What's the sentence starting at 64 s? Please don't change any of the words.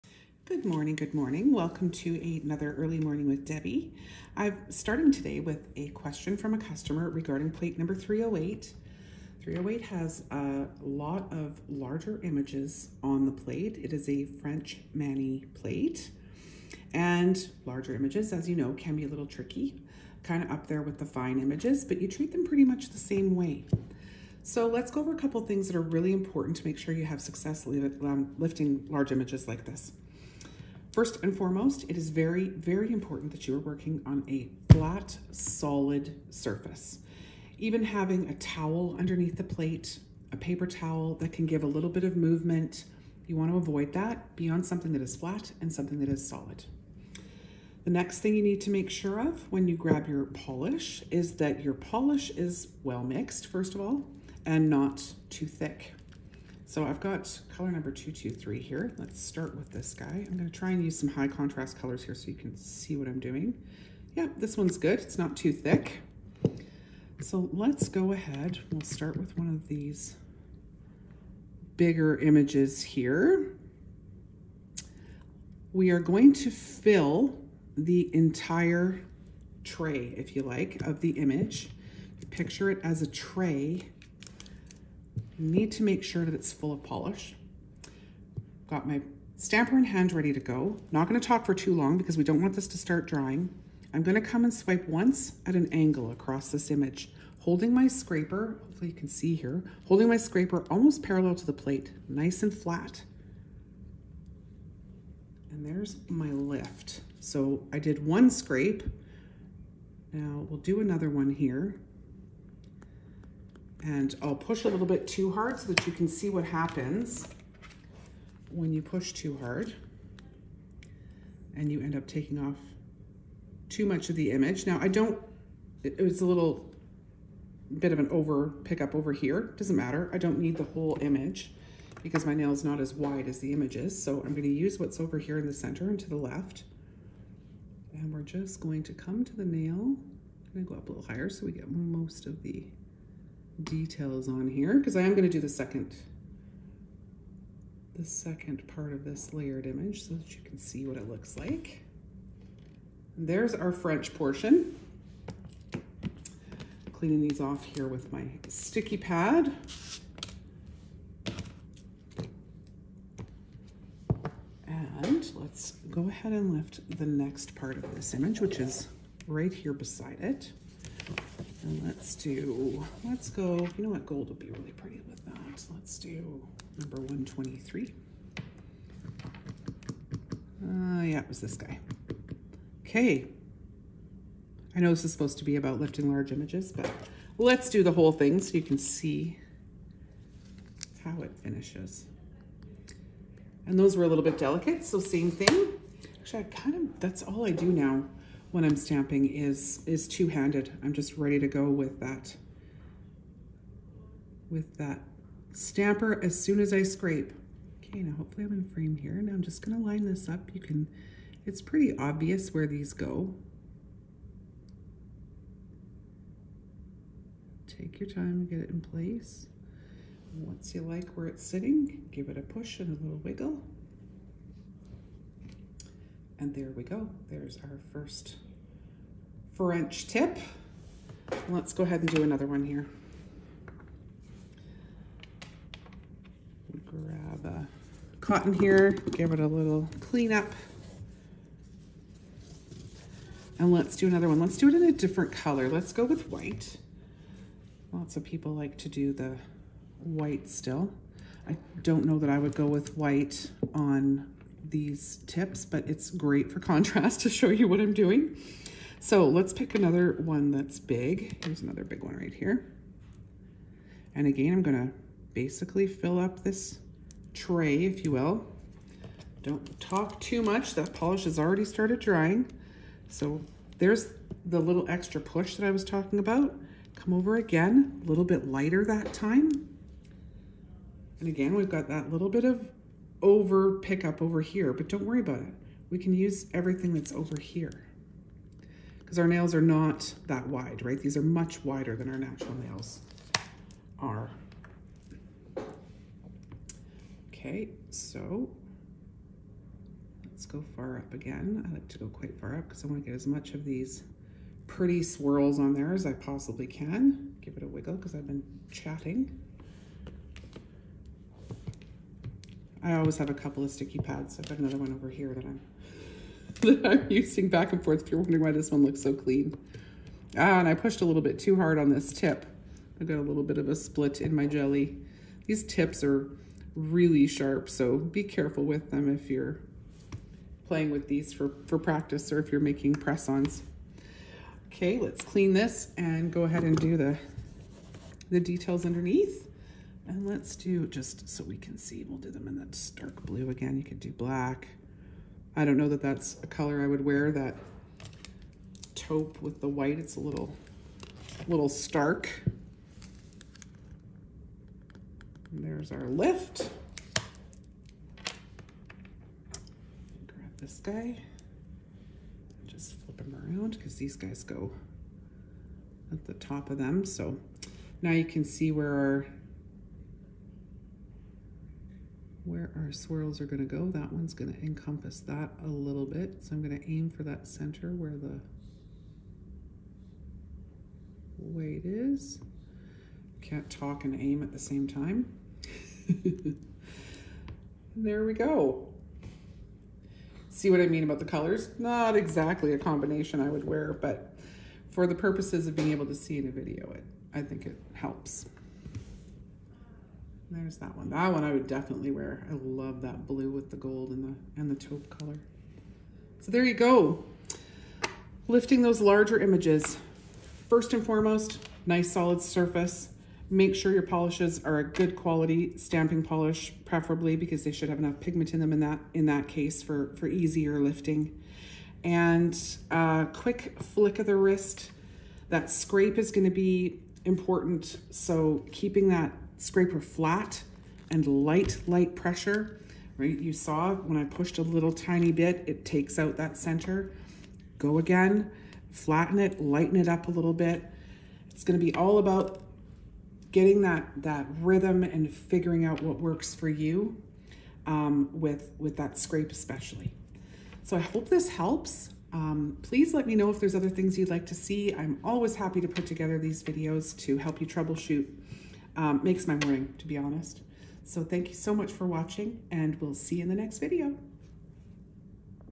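Yeah, this one's good, it's not too thick.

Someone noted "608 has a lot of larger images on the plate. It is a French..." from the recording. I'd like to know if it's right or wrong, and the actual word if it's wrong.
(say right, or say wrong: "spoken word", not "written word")
wrong: "308", not "608".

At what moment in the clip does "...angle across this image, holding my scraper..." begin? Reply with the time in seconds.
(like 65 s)
95 s.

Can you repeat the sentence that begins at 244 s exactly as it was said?
Let's do it in a different color.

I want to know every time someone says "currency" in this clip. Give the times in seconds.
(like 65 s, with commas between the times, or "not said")
not said.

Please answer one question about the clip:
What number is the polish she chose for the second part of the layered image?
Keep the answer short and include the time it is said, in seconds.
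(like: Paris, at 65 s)
123, at 176 s.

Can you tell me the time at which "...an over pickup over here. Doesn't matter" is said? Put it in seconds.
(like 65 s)
127 s.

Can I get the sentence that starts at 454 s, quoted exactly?
I'm always happy to put together these videos to help you troubleshoot um, makes my morning, to be honest.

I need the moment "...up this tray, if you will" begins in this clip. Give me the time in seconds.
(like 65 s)
266 s.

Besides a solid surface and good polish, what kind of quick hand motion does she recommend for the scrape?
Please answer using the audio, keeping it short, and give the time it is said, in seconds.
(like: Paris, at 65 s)
flick of the wrist, at 423 s.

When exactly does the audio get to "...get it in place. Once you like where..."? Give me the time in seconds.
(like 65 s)
218 s.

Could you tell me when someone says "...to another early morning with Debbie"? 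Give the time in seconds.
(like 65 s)
1 s.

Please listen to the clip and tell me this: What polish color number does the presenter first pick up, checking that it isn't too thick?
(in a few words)
223.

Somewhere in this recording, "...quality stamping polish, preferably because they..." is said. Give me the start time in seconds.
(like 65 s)
415 s.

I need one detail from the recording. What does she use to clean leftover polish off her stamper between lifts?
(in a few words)
sticky pad.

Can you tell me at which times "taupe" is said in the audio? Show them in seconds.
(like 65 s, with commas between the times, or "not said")
348 s, 404 s.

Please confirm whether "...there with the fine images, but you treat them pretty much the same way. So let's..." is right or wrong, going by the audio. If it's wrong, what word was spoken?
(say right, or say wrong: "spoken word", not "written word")
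right.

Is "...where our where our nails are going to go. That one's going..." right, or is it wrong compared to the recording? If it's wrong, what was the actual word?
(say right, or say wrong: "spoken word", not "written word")
wrong: "swirls", not "nails".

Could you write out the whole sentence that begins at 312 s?
I always have a couple of sticky pads.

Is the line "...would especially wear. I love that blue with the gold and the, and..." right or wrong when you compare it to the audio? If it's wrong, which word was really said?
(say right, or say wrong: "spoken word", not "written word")
wrong: "definitely", not "especially".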